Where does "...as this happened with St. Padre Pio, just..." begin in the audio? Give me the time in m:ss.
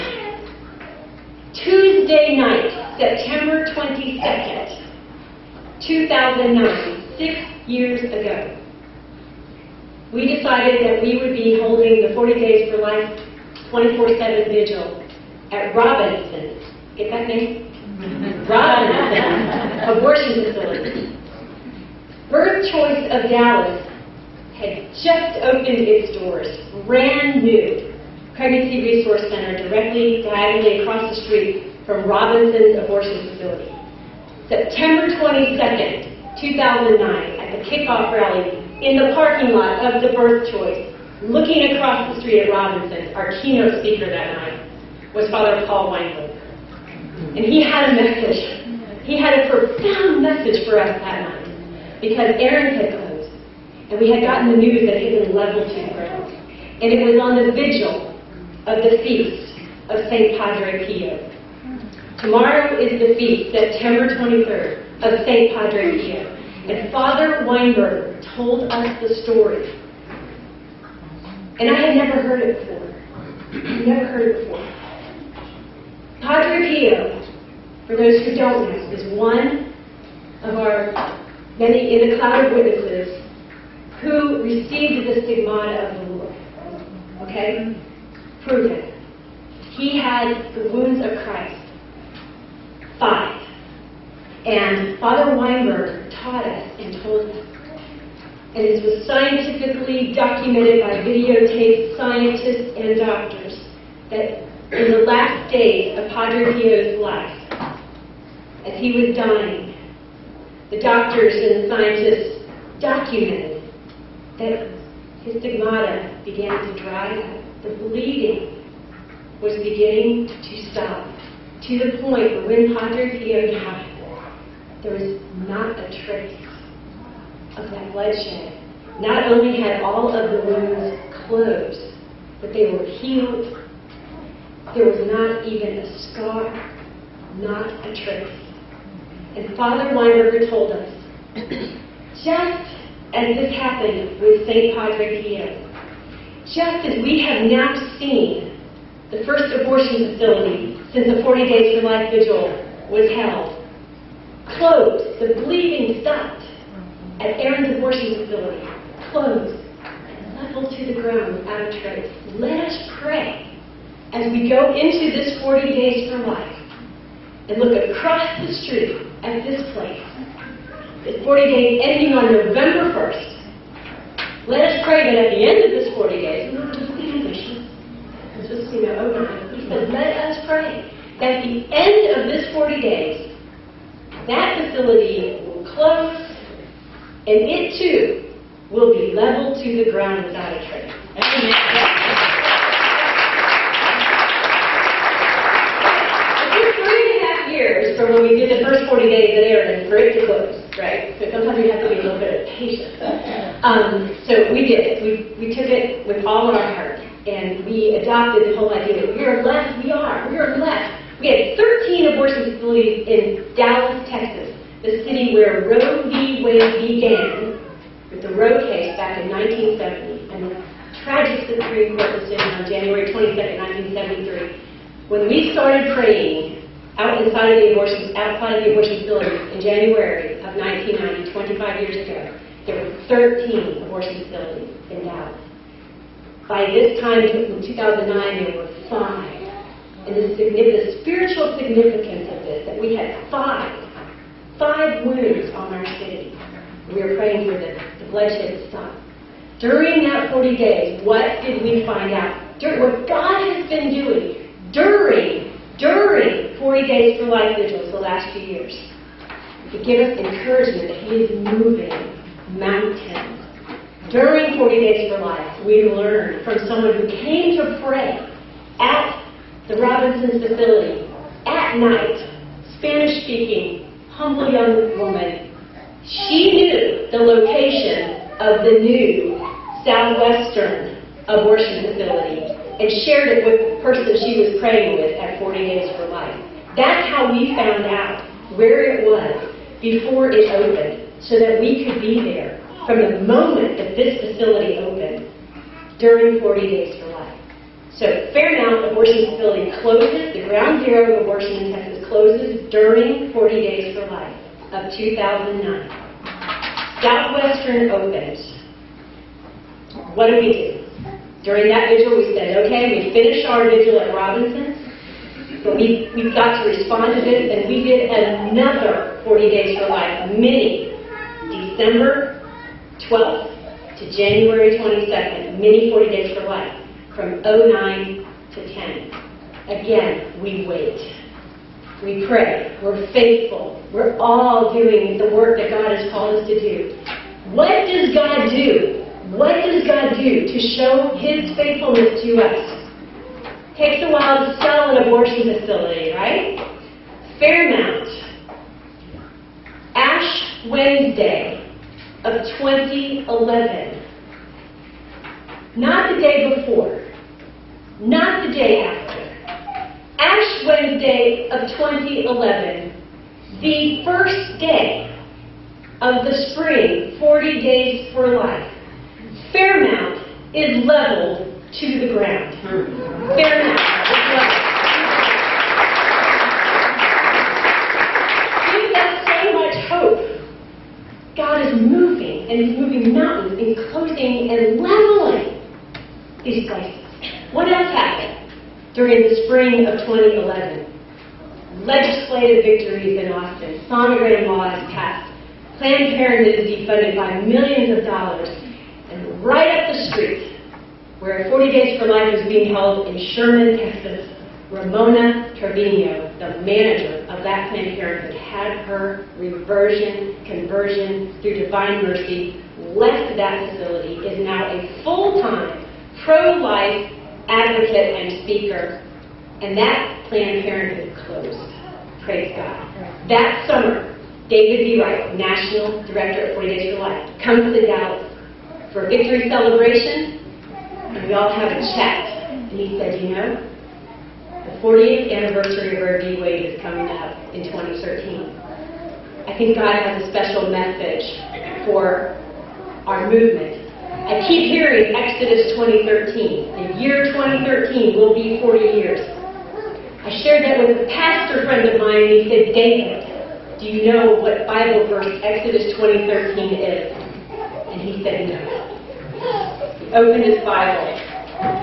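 2:23.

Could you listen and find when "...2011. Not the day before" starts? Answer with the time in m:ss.
5:52.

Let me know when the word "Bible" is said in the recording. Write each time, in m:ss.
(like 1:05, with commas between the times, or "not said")
7:34, 7:40.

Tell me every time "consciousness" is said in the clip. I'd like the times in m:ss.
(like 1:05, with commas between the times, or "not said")
not said.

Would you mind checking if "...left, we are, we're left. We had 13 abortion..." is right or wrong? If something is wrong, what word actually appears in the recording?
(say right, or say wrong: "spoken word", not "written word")
right.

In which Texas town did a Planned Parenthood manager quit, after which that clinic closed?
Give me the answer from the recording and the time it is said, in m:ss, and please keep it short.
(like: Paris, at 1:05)
Sherman, Texas, at 6:43.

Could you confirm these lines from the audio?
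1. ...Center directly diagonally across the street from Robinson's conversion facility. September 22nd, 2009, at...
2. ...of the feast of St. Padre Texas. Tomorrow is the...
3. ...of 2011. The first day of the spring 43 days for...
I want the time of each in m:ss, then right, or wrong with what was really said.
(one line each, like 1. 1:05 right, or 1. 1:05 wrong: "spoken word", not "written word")
1. 0:29 wrong: "abortion", not "conversion"
2. 0:58 wrong: "Pio", not "Texas"
3. 6:01 wrong: "40", not "43".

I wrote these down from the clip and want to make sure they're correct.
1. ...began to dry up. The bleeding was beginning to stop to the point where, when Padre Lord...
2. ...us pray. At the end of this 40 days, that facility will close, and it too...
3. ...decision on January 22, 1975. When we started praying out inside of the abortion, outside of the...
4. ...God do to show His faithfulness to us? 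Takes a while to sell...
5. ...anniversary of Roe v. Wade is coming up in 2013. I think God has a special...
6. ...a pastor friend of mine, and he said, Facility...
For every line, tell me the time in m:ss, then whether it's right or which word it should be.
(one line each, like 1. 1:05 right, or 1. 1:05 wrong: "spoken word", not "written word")
1. 1:56 wrong: "Pio", not "Lord"
2. 3:00 right
3. 3:42 wrong: "1973", not "1975"
4. 5:39 right
5. 7:15 right
6. 7:31 wrong: "David", not "Facility".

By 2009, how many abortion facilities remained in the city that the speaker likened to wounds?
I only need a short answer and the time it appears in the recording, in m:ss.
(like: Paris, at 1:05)
5, at 3:57.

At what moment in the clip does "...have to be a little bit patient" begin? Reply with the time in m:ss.
3:21.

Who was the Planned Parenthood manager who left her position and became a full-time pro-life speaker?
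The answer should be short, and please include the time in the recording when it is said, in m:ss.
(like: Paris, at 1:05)
Ramona Trevino, at 6:44.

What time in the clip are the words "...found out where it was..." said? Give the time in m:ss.
4:47.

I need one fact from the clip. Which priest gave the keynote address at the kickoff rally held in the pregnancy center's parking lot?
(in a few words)
Father Paul Weinberger.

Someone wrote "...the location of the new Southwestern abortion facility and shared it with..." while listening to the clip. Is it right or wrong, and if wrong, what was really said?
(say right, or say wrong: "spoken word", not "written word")
right.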